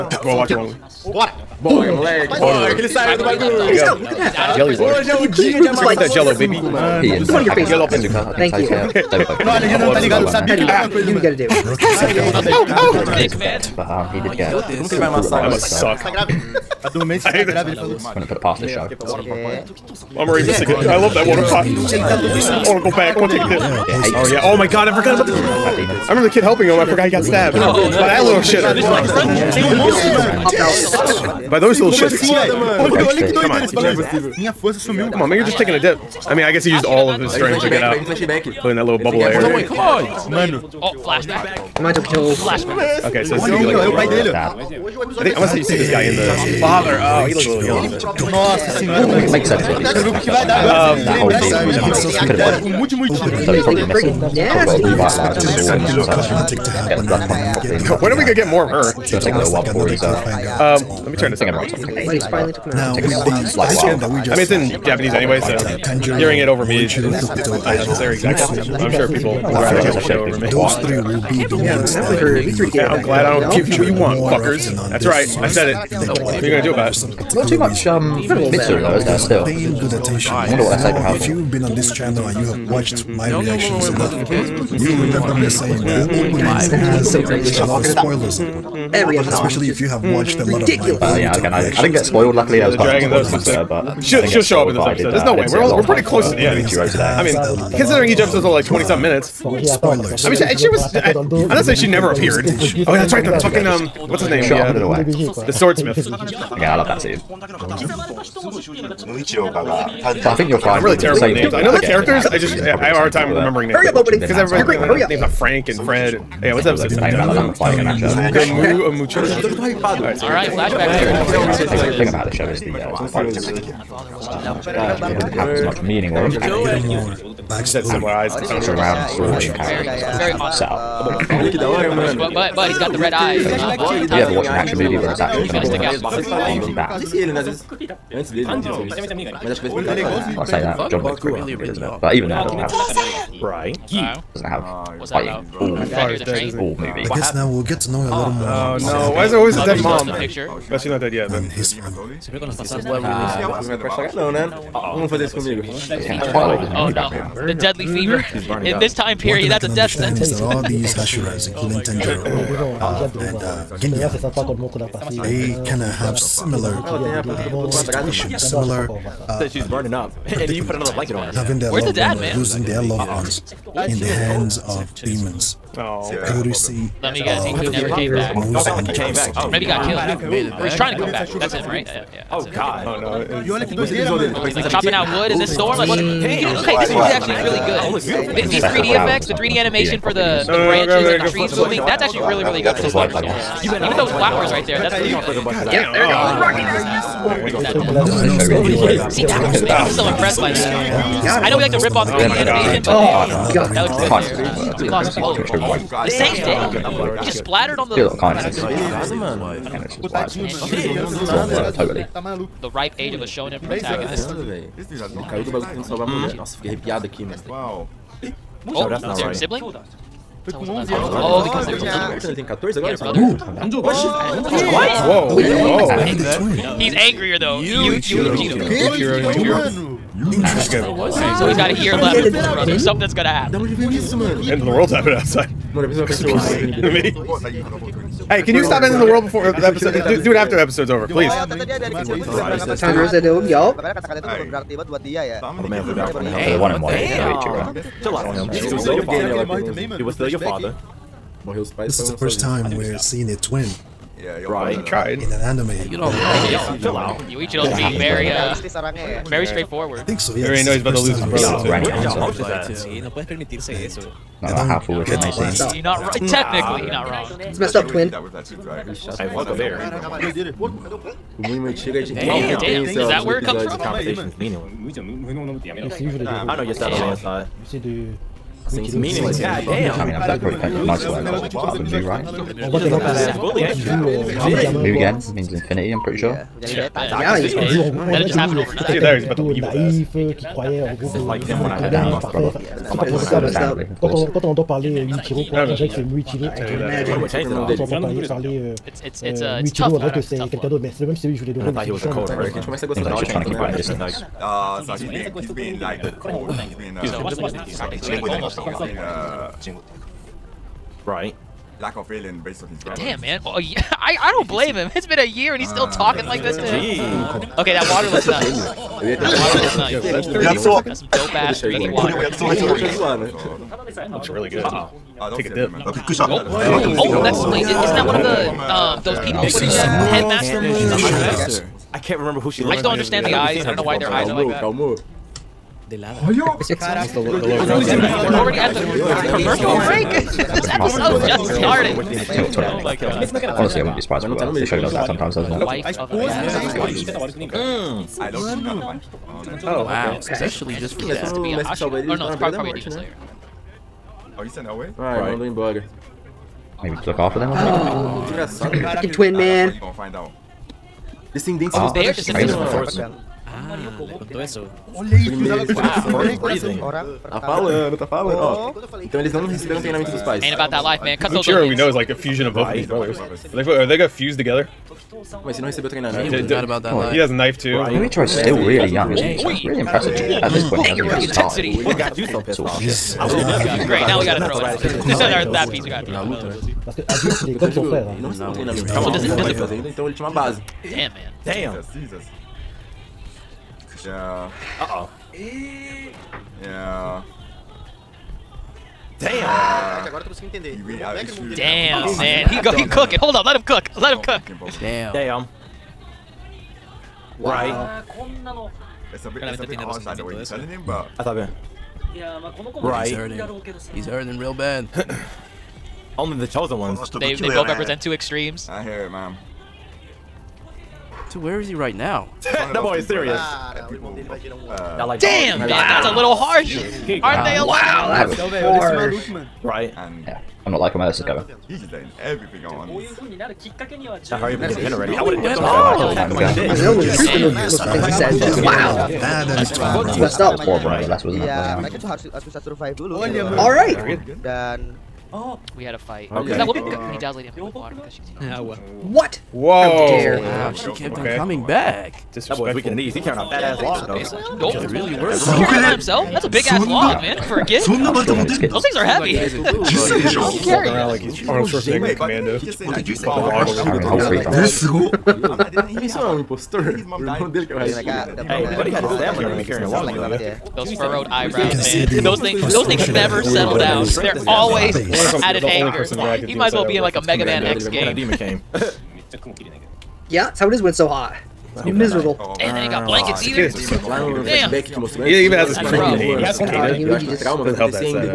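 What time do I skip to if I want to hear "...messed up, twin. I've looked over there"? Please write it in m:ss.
4:27.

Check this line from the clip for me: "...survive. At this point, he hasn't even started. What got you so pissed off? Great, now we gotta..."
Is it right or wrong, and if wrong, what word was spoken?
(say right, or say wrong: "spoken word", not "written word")
wrong: "impressive", not "survive".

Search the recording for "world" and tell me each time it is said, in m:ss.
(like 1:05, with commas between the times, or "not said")
3:54, 3:59.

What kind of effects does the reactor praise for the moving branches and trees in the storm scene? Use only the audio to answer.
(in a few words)
3D animation.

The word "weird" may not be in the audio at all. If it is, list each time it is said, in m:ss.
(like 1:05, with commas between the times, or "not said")
not said.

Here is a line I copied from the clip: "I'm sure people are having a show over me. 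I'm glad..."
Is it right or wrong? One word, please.
right.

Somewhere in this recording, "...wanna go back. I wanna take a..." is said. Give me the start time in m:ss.
0:22.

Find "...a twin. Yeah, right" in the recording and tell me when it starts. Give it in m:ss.
4:13.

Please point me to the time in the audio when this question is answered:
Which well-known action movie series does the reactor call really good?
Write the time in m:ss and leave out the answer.
2:20.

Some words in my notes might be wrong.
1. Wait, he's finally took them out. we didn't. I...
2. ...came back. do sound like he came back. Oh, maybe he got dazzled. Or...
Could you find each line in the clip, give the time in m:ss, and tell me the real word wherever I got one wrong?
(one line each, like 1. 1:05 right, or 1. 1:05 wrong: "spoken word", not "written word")
1. 1:01 right
2. 2:57 wrong: "killed", not "dazzled".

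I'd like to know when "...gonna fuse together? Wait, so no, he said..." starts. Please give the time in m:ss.
6:13.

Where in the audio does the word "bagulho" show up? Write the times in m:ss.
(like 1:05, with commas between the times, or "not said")
0:03, 3:35.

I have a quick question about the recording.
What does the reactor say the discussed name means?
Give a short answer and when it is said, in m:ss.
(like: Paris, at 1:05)
infinity, at 4:45.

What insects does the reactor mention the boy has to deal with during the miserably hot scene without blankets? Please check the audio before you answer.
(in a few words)
cicadas.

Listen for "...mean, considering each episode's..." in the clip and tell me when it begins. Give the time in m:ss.
1:37.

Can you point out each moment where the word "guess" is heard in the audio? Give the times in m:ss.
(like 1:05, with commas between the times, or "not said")
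0:36, 2:27, 2:57.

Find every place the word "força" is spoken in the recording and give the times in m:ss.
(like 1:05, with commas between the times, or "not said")
0:34.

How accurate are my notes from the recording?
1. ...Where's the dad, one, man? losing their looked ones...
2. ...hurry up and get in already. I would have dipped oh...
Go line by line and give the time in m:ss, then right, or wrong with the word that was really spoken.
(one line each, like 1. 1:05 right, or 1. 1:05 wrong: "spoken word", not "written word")
1. 2:51 wrong: "loved", not "looked"
2. 7:14 right.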